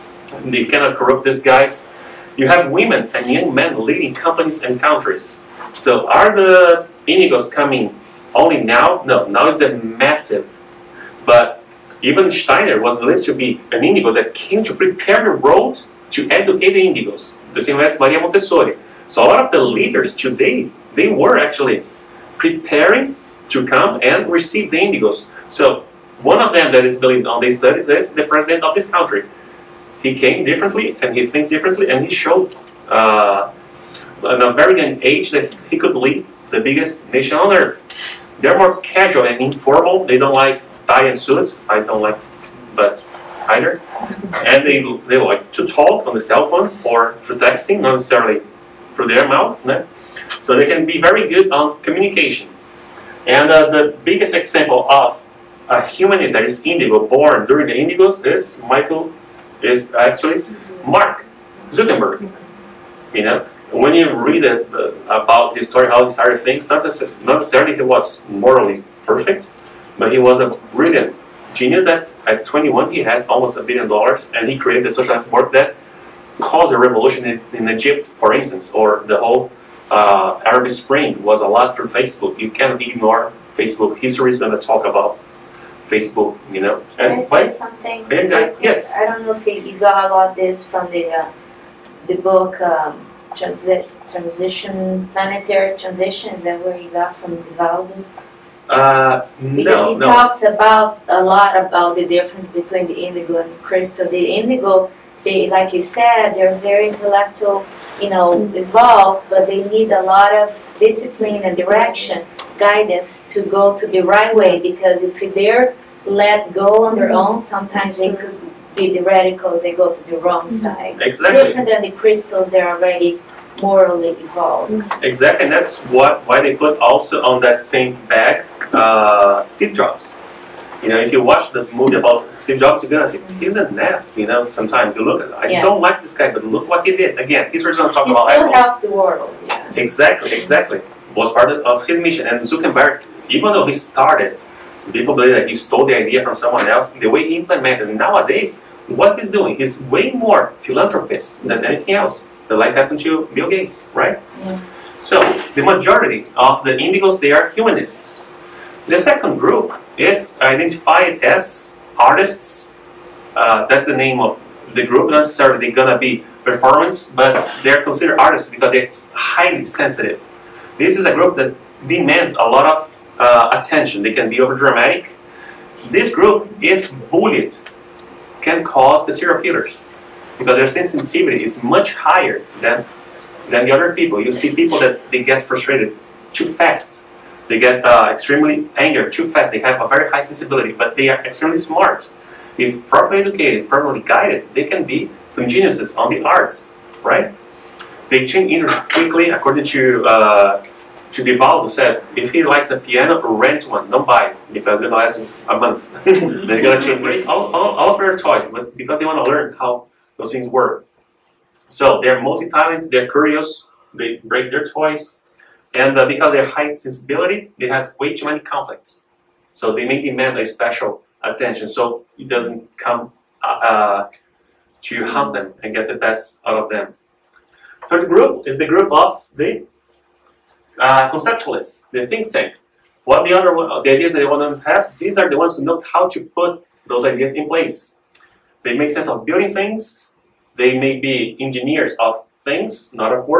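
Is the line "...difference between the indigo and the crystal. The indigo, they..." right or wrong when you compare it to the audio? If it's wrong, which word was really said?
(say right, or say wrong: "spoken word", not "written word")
right.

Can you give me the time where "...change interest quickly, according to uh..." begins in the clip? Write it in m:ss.
3:18.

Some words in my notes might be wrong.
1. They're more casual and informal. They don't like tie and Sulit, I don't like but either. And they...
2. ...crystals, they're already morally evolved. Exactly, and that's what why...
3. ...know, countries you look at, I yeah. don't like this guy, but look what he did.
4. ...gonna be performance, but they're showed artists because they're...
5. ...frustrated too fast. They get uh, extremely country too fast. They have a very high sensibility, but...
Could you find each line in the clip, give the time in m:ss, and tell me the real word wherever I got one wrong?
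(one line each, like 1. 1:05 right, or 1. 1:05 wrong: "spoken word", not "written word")
1. 0:38 right
2. 2:01 right
3. 2:14 wrong: "sometimes", not "countries"
4. 2:45 wrong: "considered", not "showed"
5. 3:05 wrong: "angry", not "country".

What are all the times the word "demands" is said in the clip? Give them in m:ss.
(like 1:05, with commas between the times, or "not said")
2:51, 3:40.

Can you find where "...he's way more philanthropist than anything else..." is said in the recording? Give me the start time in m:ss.
2:29.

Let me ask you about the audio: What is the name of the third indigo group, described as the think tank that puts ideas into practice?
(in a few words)
conceptualists.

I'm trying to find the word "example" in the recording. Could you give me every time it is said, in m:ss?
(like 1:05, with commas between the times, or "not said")
0:54.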